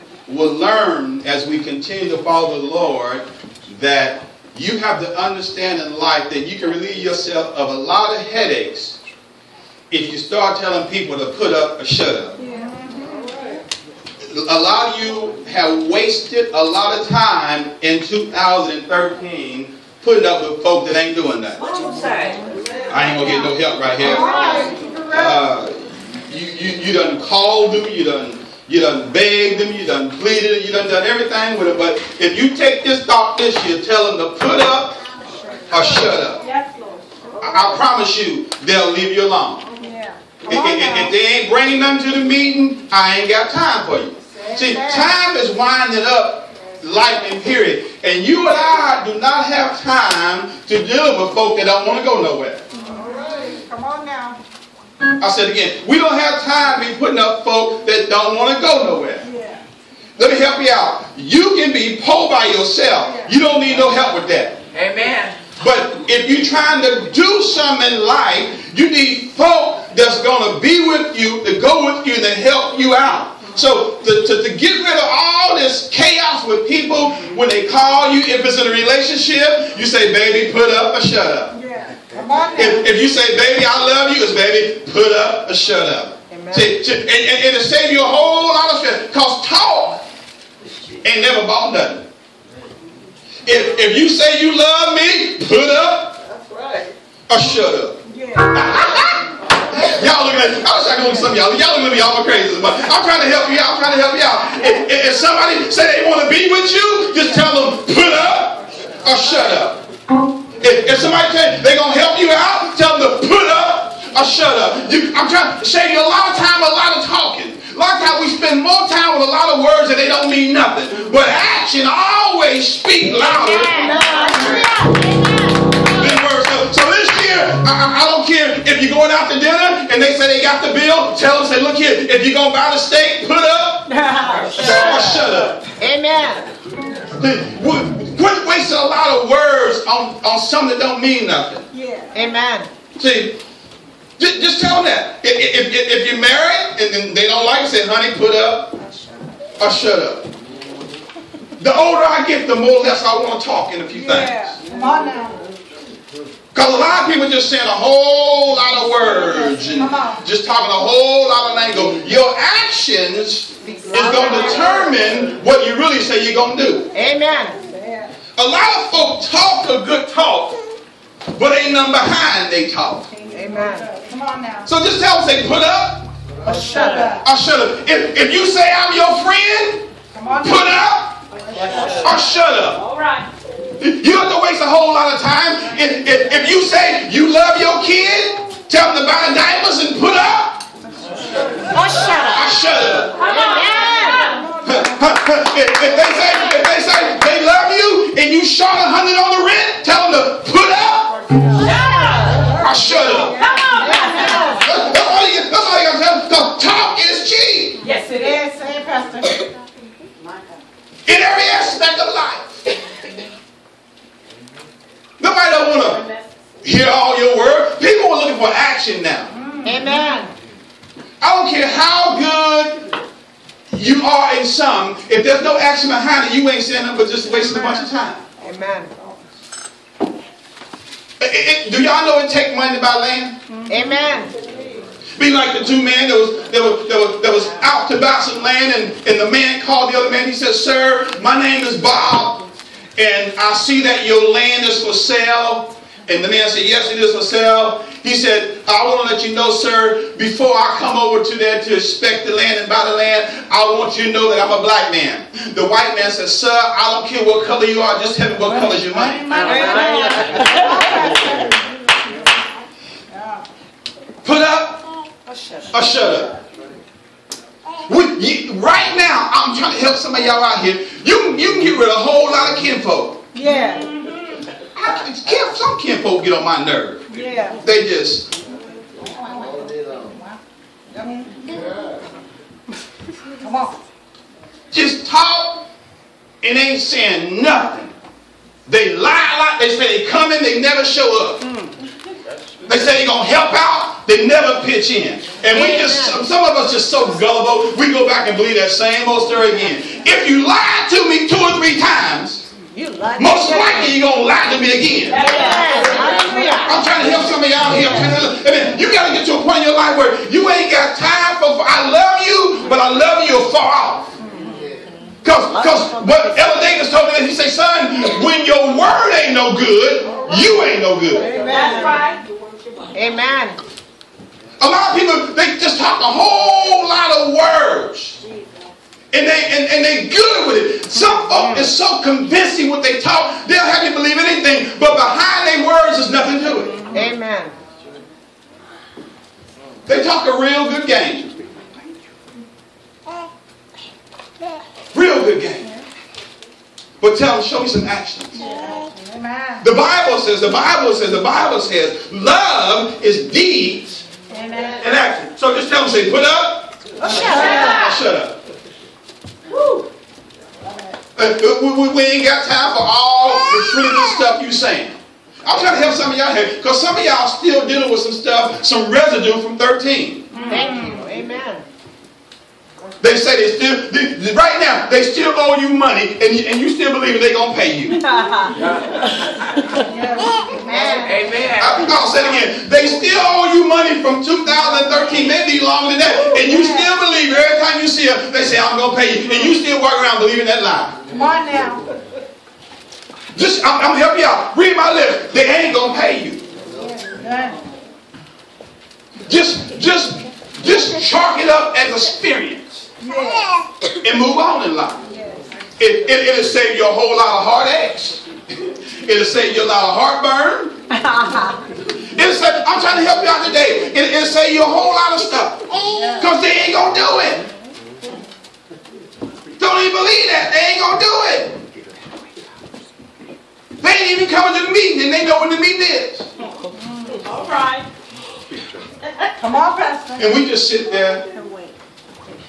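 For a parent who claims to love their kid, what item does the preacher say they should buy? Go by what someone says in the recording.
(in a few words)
Diapers.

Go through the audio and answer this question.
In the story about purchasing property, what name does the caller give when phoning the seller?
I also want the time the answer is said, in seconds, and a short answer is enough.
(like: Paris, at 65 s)
Bob, at 241 s.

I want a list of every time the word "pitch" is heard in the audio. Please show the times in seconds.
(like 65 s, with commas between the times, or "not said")
294 s.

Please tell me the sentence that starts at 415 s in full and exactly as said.
Because they ain't going to do it.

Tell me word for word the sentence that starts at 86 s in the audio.
See, and, and, and it'll save you a whole lot of stress.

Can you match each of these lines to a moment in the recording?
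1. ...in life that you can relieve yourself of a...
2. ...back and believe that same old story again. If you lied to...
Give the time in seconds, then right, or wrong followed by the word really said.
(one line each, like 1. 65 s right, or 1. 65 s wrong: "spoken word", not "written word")
1. 5 s right
2. 298 s right.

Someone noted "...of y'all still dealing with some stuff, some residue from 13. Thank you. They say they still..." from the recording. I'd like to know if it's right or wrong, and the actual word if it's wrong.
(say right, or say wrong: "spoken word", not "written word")
right.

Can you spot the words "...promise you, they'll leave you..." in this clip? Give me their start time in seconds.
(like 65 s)
37 s.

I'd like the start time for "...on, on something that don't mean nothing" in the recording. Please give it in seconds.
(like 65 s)
139 s.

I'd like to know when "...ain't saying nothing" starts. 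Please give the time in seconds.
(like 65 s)
286 s.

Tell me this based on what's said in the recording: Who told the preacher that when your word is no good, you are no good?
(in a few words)
Elder Davis.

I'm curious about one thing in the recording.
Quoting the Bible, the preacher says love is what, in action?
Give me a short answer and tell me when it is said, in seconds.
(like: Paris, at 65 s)
Deeds, at 353 s.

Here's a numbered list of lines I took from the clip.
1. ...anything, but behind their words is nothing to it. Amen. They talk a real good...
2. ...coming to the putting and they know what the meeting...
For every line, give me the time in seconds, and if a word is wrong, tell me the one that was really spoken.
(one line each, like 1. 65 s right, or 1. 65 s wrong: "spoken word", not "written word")
1. 334 s right
2. 424 s wrong: "meeting", not "putting".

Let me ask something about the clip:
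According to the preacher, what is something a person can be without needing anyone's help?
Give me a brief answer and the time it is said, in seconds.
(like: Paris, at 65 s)
Poor, at 62 s.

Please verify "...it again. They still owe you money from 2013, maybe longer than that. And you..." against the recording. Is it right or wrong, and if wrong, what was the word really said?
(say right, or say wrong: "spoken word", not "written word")
right.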